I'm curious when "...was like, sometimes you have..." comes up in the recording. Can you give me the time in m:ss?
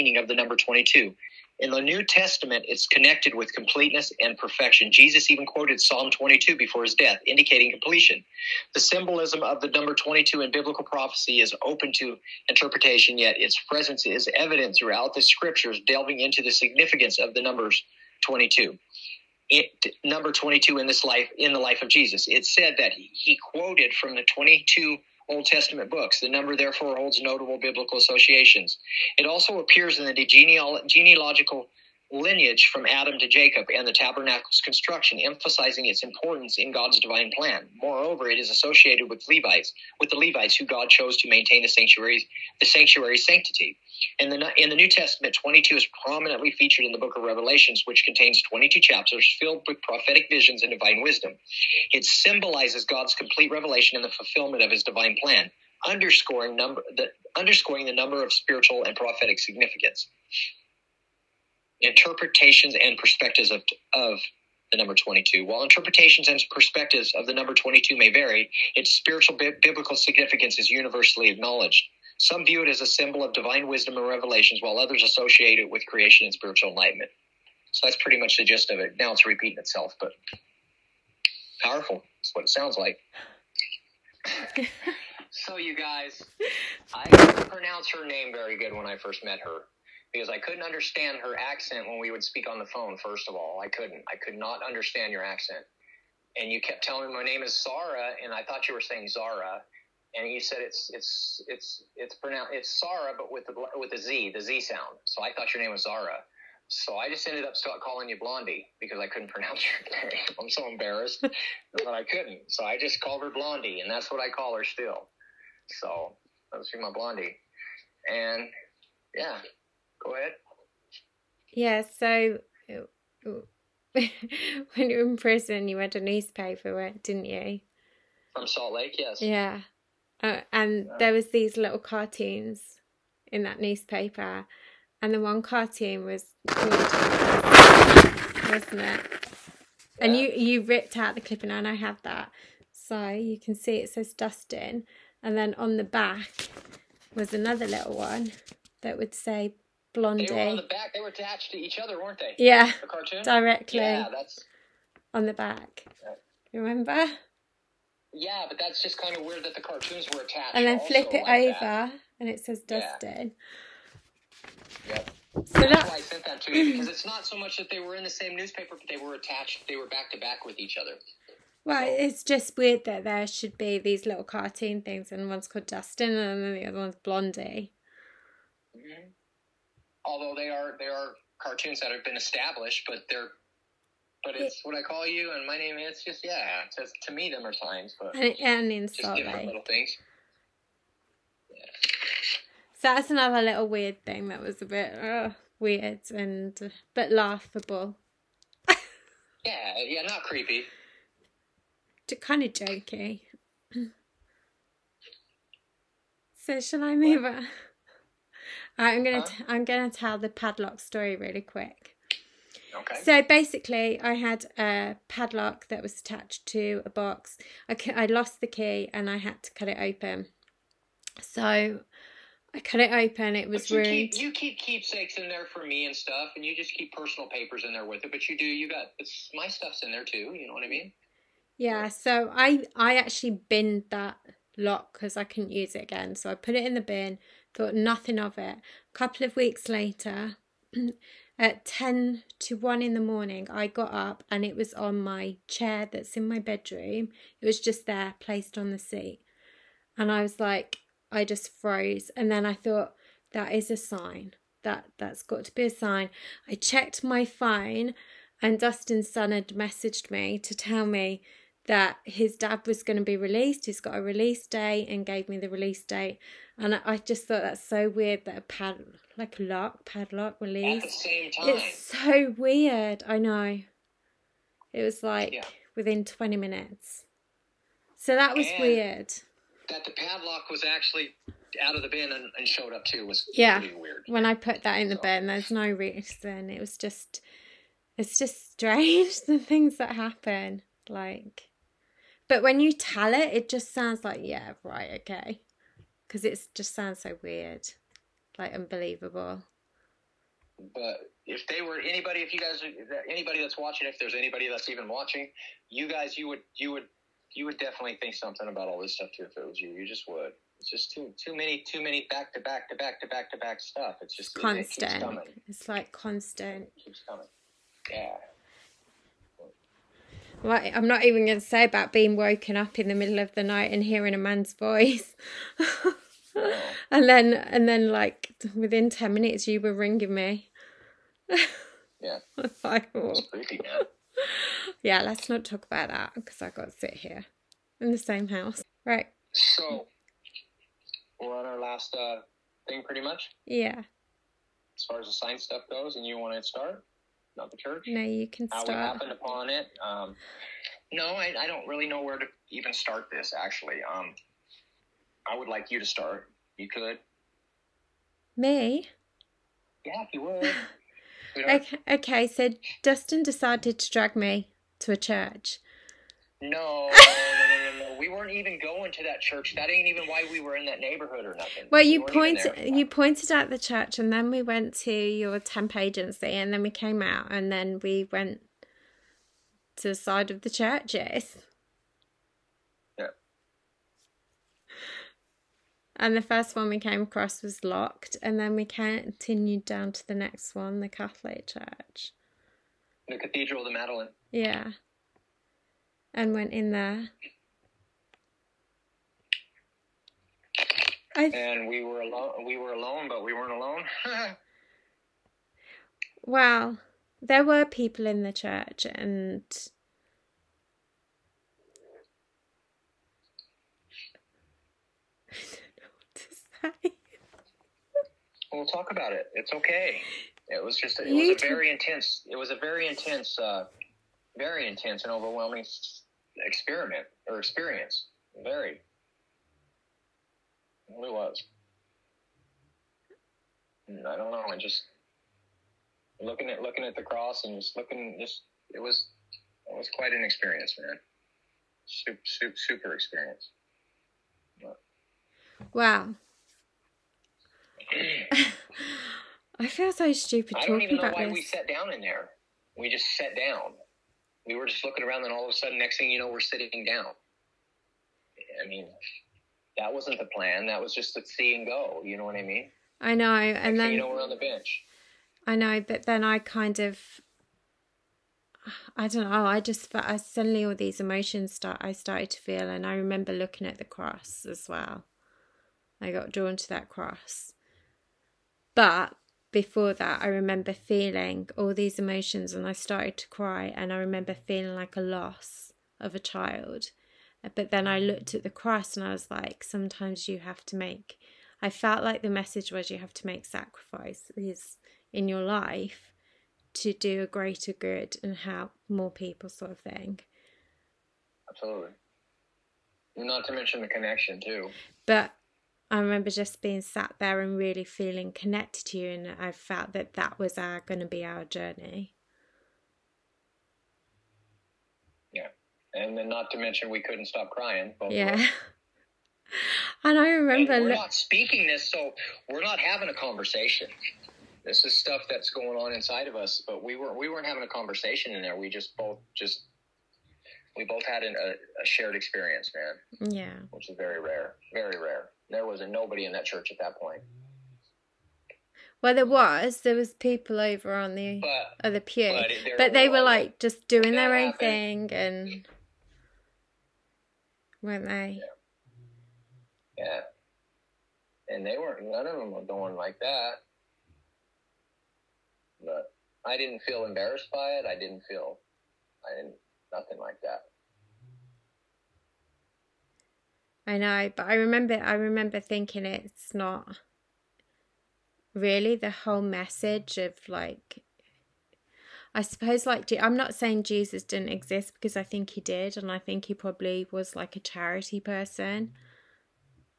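8:09.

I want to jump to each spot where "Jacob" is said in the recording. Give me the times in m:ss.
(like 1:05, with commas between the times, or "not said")
0:33.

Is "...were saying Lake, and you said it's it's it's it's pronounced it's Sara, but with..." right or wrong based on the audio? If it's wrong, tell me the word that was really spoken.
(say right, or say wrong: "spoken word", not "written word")
wrong: "Zara", not "Lake".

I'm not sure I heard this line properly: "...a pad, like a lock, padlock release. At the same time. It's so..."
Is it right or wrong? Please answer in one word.
right.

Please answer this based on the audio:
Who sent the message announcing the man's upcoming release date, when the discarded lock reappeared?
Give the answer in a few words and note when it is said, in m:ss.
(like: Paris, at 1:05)
Dustin's son, at 4:18.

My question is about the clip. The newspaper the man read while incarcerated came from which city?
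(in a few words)
Salt Lake.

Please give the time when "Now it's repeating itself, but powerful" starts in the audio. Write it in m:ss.
1:18.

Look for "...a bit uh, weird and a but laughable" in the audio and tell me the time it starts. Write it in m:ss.
3:14.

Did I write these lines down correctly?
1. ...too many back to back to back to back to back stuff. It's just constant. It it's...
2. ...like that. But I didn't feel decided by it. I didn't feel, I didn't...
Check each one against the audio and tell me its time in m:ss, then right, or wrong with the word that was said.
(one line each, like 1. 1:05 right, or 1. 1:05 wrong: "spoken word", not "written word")
1. 5:11 right
2. 9:12 wrong: "embarrassed", not "decided".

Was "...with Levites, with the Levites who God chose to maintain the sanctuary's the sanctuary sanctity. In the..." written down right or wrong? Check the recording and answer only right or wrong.
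right.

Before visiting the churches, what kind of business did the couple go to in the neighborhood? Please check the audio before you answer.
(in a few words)
temp agency.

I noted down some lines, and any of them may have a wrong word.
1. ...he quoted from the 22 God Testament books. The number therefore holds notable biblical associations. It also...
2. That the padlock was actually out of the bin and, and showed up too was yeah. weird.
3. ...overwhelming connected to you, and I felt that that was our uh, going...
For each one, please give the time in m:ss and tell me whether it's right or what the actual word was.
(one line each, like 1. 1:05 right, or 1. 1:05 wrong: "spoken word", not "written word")
1. 0:22 wrong: "Old", not "God"
2. 4:39 right
3. 8:27 wrong: "feeling", not "overwhelming".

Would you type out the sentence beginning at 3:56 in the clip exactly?
So I put it in the bin thought nothing of it.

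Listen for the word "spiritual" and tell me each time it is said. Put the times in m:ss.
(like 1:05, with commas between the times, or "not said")
0:58, 1:08, 1:16.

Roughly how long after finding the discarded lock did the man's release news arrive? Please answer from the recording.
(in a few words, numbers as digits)
20 minutes.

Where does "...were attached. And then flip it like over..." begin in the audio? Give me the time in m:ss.
2:40.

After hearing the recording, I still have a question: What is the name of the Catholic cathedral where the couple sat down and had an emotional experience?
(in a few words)
Cathedral of the Madeleine.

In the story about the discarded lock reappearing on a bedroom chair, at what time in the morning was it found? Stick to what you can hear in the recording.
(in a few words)
10 to 1.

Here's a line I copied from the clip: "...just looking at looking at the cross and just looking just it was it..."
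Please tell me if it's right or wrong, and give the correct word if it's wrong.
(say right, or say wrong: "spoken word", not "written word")
right.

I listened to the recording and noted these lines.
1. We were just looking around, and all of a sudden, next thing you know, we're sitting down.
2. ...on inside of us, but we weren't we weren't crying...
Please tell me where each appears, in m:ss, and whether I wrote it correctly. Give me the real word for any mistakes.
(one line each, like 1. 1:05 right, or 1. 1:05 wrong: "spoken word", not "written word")
1. 7:34 right
2. 8:45 wrong: "having", not "crying".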